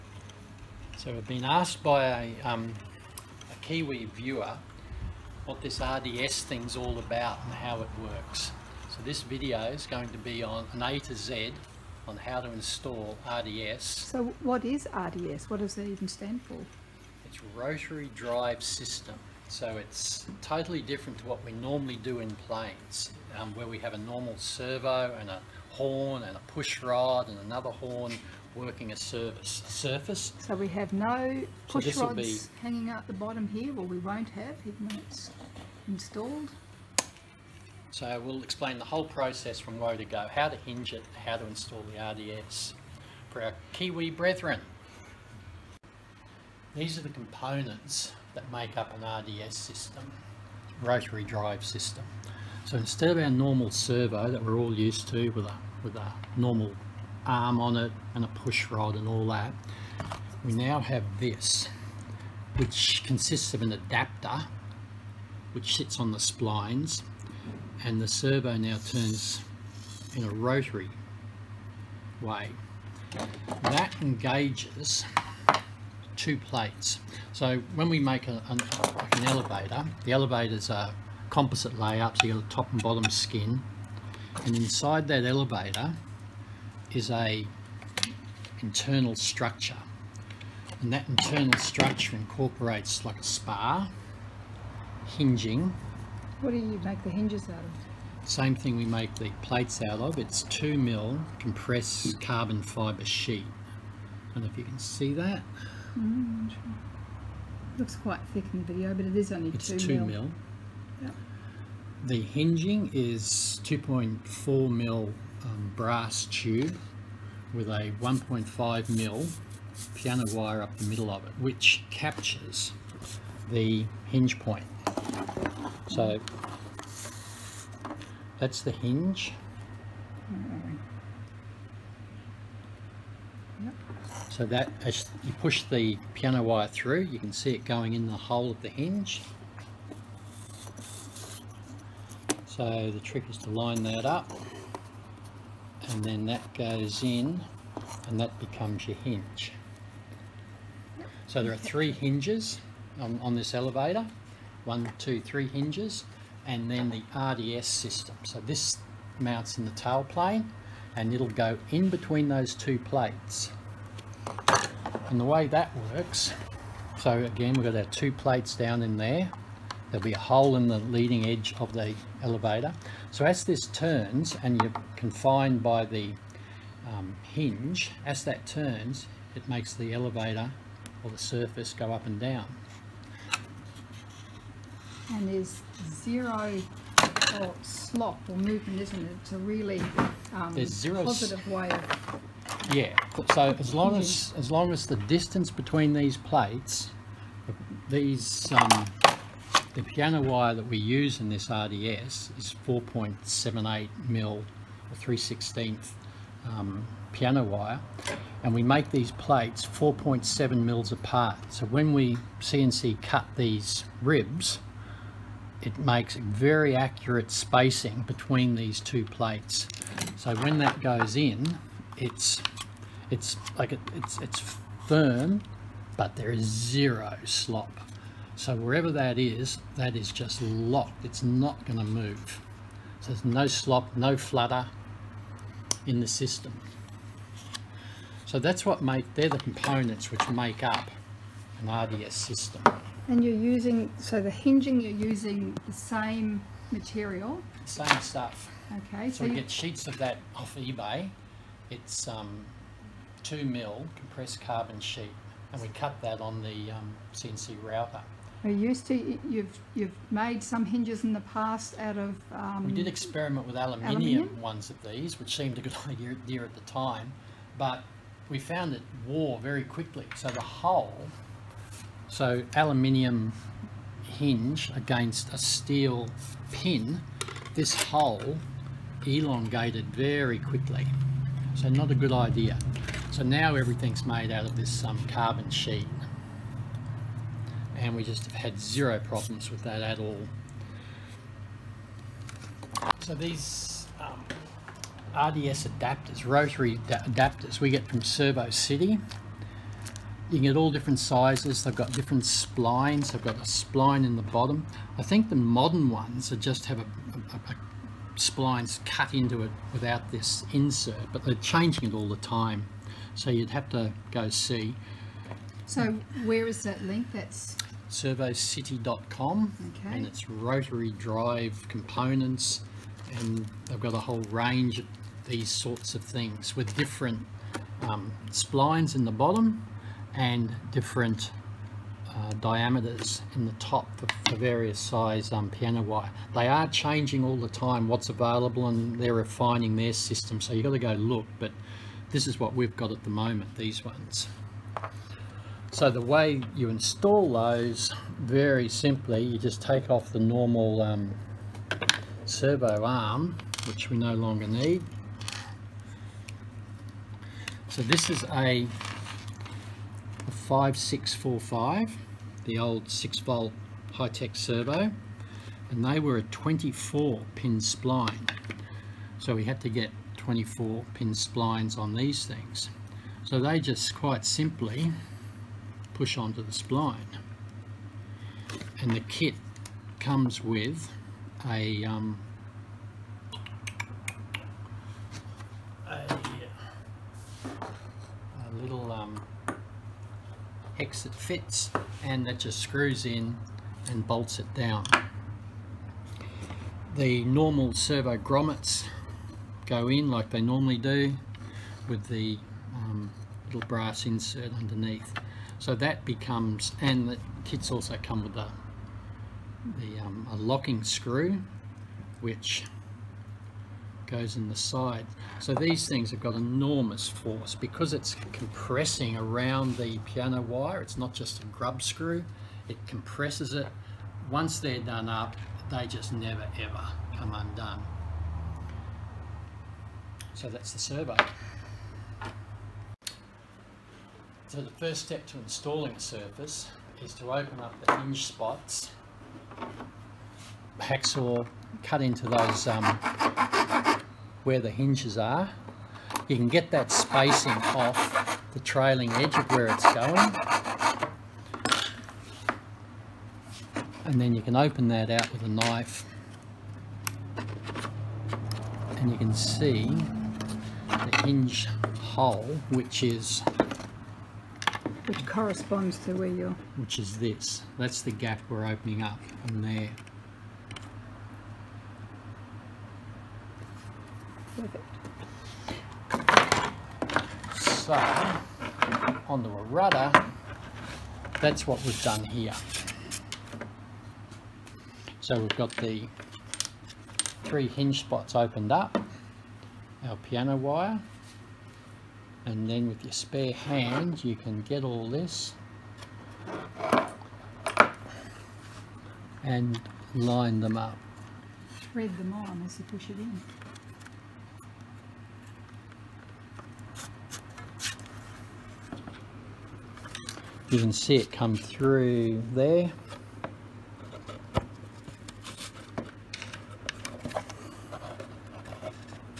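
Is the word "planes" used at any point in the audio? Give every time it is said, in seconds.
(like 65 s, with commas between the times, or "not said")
22 s, 160 s.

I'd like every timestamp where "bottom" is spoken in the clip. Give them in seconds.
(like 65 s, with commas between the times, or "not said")
33 s, 82 s, 304 s, 329 s.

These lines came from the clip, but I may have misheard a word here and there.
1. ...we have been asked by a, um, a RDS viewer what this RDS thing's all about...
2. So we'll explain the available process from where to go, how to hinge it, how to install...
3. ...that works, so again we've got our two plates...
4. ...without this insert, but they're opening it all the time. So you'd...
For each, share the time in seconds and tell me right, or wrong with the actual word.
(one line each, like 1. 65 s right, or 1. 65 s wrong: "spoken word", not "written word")
1. 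1 s wrong: "Kiwi", not "RDS"
2. 37 s wrong: "whole", not "available"
3. 165 s right
4. 309 s wrong: "changing", not "opening".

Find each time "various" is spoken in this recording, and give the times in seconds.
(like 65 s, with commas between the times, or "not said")
334 s.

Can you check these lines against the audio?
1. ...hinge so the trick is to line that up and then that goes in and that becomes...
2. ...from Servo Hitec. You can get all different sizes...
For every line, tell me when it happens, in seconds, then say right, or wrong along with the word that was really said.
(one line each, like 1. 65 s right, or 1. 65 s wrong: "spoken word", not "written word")
1. 138 s right
2. 297 s wrong: "City", not "Hitec".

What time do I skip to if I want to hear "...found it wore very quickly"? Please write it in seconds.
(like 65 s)
268 s.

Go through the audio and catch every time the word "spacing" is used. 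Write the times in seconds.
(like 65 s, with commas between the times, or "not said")
217 s, 446 s.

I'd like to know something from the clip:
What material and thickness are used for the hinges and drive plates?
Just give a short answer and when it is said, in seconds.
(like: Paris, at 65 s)
2 mil compressed carbon fibre sheet, at 100 s.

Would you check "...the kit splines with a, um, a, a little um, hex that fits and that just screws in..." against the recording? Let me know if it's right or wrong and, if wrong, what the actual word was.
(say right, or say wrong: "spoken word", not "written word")
wrong: "comes", not "splines".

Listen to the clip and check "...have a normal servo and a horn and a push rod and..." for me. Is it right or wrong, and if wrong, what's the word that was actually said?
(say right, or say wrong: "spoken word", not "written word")
right.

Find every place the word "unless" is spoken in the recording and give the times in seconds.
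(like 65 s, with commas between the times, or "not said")
not said.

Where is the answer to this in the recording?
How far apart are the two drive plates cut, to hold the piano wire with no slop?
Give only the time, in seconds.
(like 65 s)
209 s.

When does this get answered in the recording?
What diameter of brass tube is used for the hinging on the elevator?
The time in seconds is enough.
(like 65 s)
113 s.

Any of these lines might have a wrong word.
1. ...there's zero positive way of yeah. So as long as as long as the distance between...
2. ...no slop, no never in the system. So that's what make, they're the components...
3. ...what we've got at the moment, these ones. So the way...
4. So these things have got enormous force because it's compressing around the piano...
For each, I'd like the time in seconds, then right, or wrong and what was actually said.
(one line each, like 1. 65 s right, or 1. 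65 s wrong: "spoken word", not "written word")
1. 190 s right
2. 233 s wrong: "flutter", not "never"
3. 342 s right
4. 415 s right.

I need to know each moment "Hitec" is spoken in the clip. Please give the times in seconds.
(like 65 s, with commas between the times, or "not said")
363 s.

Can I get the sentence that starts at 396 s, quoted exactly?
The normal servo grommets go in like they normally do with the um, little brass insert underneath.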